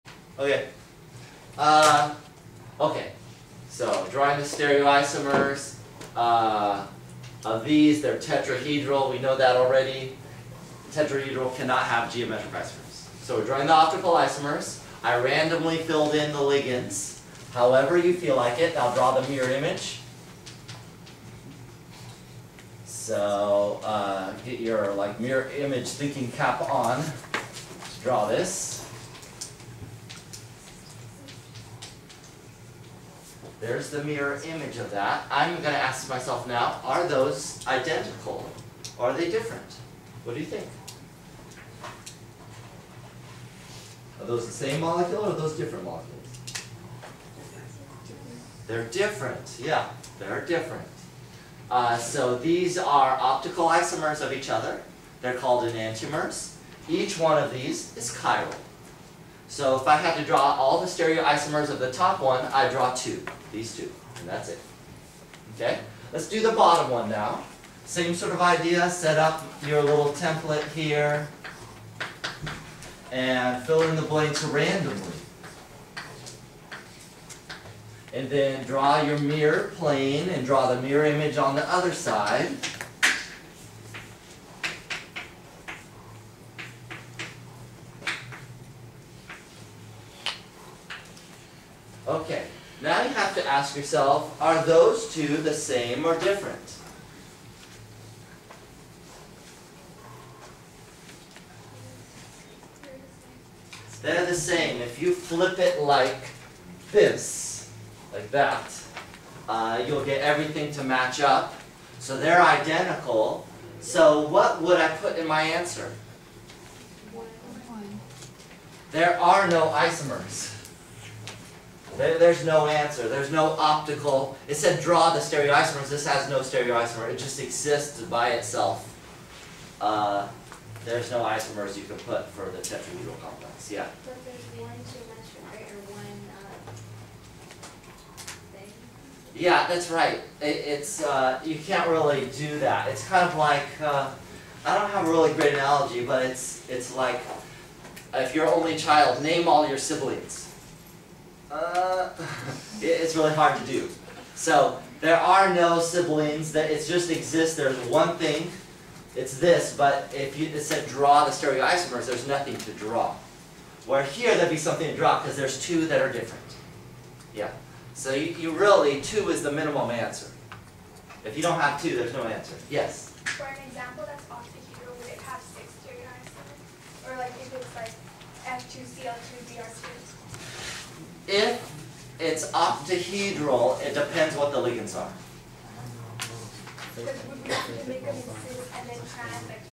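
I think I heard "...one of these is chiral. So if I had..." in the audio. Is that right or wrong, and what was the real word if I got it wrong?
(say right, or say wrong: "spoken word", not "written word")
right.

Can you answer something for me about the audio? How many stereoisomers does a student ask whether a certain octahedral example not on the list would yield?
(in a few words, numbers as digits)
6.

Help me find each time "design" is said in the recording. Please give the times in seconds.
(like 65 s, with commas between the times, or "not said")
not said.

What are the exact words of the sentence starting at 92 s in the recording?
Okay, now you have to ask yourself, are those two the same or different?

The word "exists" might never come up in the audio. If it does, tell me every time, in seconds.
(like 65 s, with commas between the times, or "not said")
127 s, 157 s.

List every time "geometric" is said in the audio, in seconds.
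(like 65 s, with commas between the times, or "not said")
12 s.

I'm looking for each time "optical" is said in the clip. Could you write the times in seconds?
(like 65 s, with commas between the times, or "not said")
13 s, 53 s, 123 s.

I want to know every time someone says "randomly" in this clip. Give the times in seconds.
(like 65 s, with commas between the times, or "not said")
15 s, 74 s.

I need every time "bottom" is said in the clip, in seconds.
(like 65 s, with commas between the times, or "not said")
66 s.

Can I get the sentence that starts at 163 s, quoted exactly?
Where here there'd be something to draw because there's two that are different.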